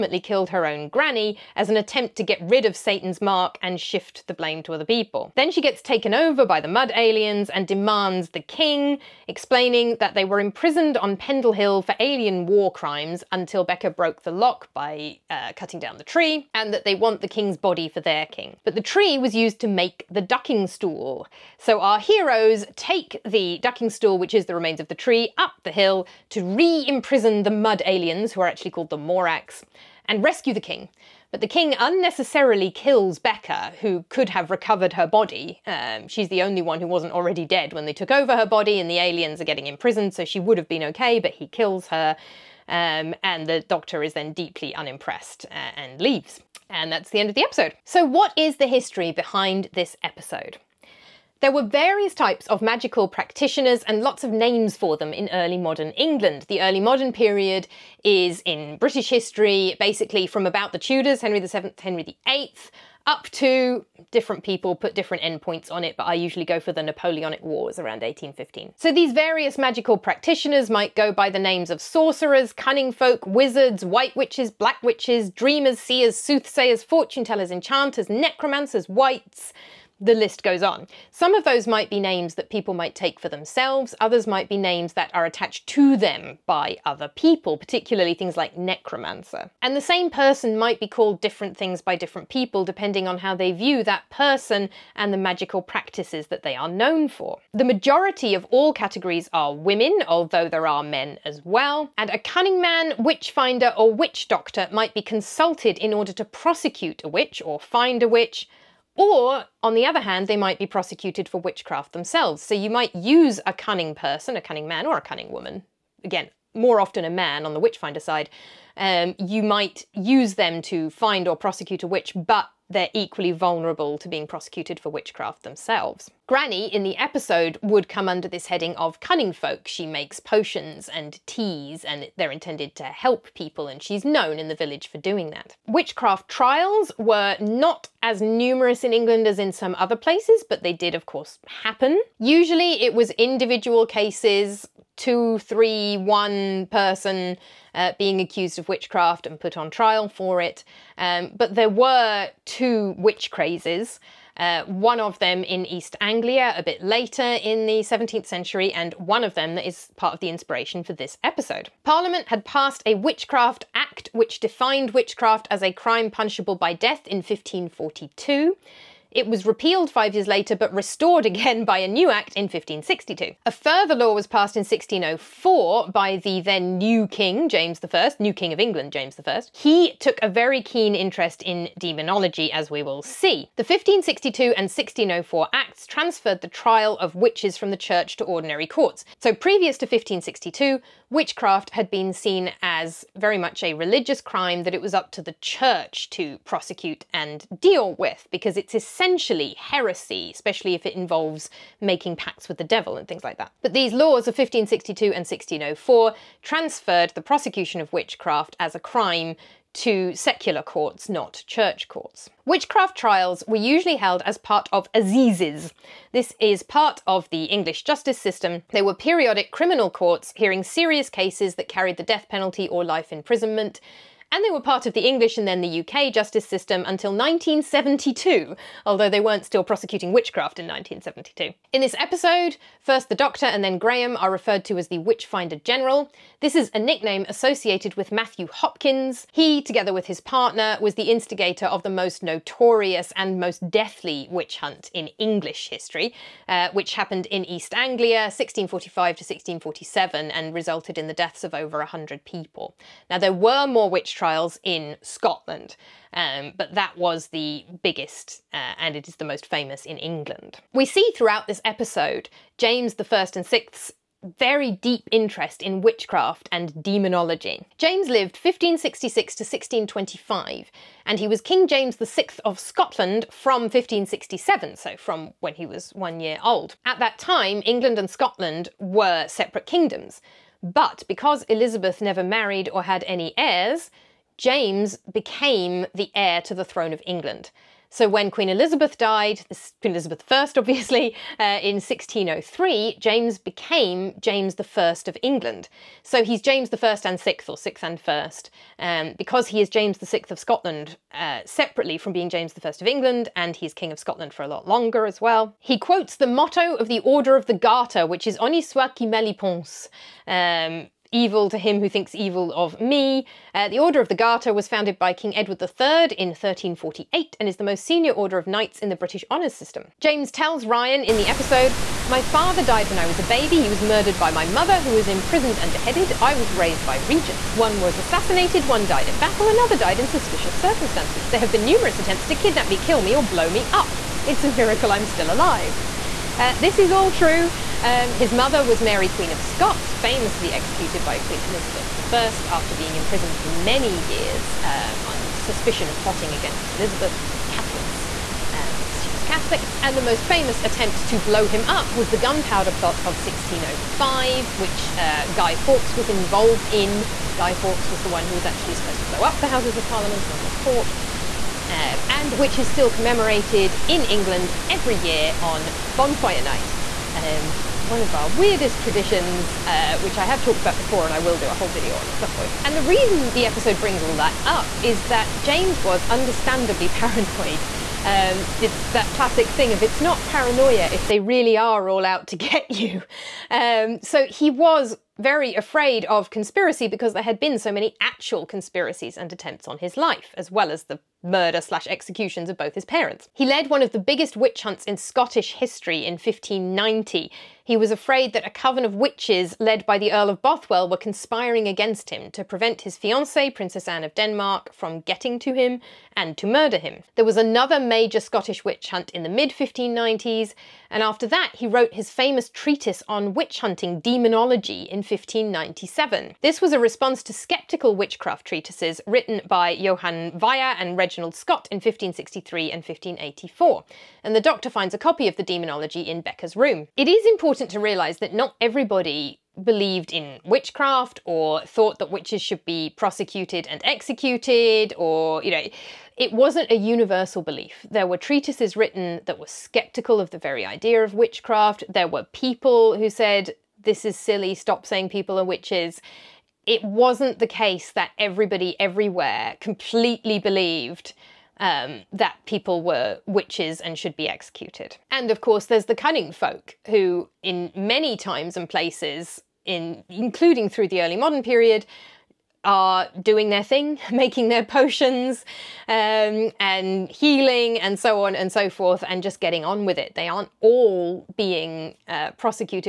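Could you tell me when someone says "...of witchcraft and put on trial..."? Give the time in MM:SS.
02:28.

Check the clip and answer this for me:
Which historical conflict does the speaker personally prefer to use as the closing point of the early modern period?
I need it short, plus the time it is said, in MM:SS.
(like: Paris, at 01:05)
Napoleonic Wars, at 01:06.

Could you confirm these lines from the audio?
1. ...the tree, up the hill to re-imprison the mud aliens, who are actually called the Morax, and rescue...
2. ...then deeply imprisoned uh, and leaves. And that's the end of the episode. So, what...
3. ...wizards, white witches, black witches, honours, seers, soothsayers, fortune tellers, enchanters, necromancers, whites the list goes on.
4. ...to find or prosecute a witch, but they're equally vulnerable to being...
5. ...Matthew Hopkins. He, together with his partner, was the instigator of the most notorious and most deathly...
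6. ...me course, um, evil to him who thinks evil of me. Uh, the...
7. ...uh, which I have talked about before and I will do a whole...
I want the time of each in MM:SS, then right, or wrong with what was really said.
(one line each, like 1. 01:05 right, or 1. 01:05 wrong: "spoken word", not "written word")
1. 00:24 right
2. 00:44 wrong: "unimpressed", not "imprisoned"
3. 01:13 wrong: "dreamers", not "honours"
4. 02:00 right
5. 03:58 right
6. 05:09 wrong: "pense", not "course"
7. 06:09 right.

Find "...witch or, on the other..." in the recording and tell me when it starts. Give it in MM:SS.
01:48.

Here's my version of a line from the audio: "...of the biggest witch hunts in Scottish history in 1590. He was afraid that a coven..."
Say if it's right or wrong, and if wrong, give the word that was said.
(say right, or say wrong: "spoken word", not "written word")
right.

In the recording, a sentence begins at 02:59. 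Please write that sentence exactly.
He took a very keen interest in demonology, as we will see.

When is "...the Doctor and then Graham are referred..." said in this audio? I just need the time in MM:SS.
03:53.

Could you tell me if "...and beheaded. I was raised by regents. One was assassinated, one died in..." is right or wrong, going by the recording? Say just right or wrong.
right.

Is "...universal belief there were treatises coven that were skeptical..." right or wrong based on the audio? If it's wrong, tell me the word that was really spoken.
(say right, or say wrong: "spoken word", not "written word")
wrong: "written", not "coven".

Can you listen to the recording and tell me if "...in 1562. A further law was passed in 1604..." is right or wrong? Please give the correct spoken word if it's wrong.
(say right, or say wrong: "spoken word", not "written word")
right.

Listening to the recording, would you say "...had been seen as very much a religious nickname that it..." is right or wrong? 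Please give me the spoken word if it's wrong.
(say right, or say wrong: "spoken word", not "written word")
wrong: "crime", not "nickname".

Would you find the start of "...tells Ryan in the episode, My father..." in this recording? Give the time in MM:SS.
05:20.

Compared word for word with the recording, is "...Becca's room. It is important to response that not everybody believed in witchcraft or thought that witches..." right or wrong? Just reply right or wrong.
wrong.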